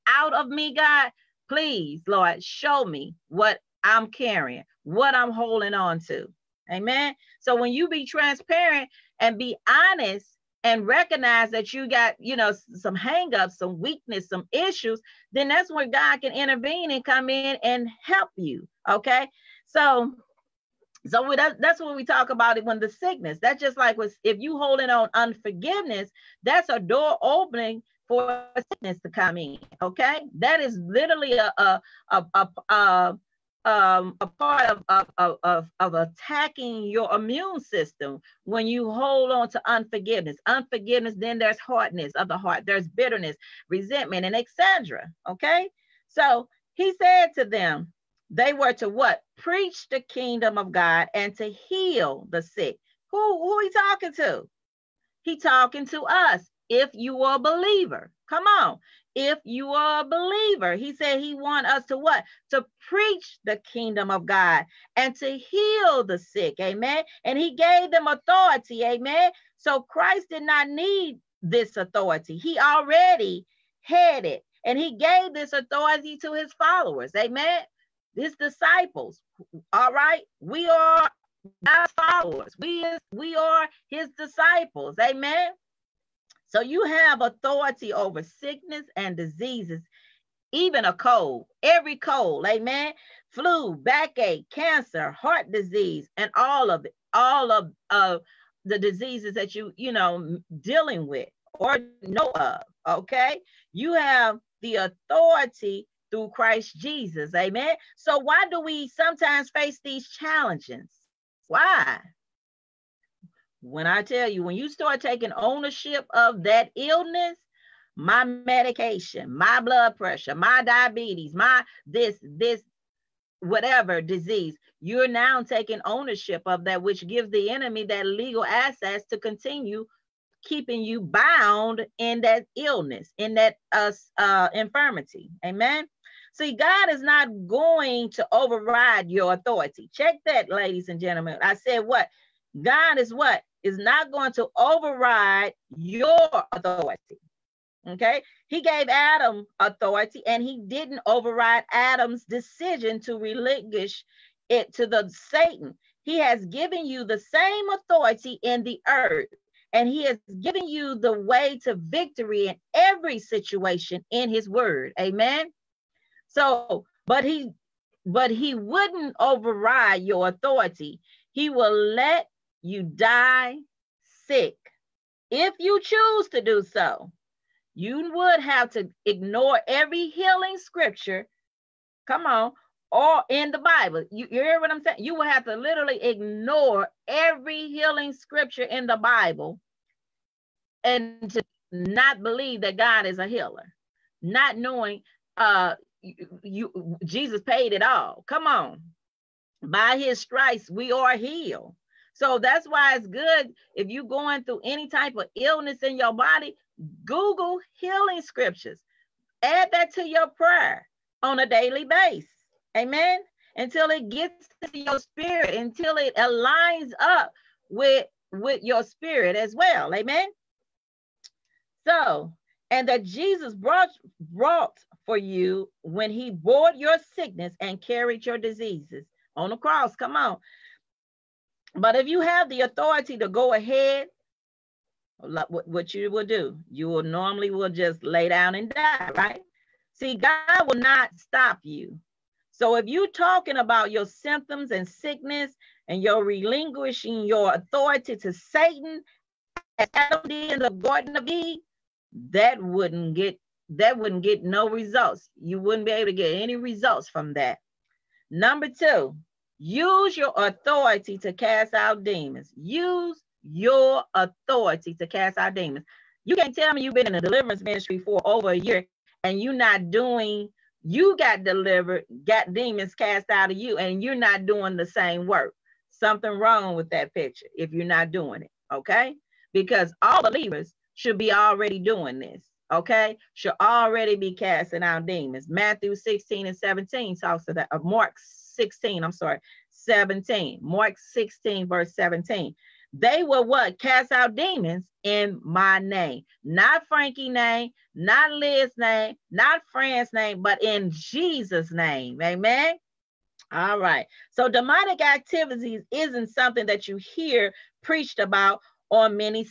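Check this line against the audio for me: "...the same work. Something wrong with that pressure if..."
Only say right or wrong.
wrong.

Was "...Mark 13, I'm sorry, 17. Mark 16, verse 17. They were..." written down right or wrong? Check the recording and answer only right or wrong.
wrong.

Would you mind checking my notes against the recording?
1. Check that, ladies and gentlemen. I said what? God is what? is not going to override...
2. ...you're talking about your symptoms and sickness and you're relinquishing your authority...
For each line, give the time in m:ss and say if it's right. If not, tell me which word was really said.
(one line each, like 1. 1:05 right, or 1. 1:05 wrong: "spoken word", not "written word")
1. 2:19 right
2. 4:02 right.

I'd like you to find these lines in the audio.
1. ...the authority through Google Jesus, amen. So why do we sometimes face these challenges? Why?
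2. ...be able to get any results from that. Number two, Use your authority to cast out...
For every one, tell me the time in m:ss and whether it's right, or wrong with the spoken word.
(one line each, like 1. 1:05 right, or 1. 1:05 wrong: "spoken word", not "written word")
1. 1:44 wrong: "Christ", not "Google"
2. 4:15 right.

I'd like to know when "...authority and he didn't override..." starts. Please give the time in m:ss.
2:29.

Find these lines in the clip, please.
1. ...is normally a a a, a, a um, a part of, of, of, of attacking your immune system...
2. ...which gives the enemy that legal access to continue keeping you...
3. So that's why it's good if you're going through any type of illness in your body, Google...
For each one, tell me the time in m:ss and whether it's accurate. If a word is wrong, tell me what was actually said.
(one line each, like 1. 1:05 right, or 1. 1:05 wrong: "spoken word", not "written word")
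1. 0:30 wrong: "literally", not "normally"
2. 2:06 right
3. 3:22 right.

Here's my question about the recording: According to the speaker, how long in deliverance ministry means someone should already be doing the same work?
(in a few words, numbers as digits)
A year.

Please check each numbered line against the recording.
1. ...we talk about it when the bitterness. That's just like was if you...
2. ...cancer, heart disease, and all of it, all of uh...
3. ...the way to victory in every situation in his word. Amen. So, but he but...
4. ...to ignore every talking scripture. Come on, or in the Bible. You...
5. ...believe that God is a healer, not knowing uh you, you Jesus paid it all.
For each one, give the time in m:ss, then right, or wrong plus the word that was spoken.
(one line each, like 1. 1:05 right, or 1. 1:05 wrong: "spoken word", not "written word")
1. 0:21 wrong: "sickness", not "bitterness"
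2. 1:34 right
3. 2:40 right
4. 2:58 wrong: "healing", not "talking"
5. 3:12 right.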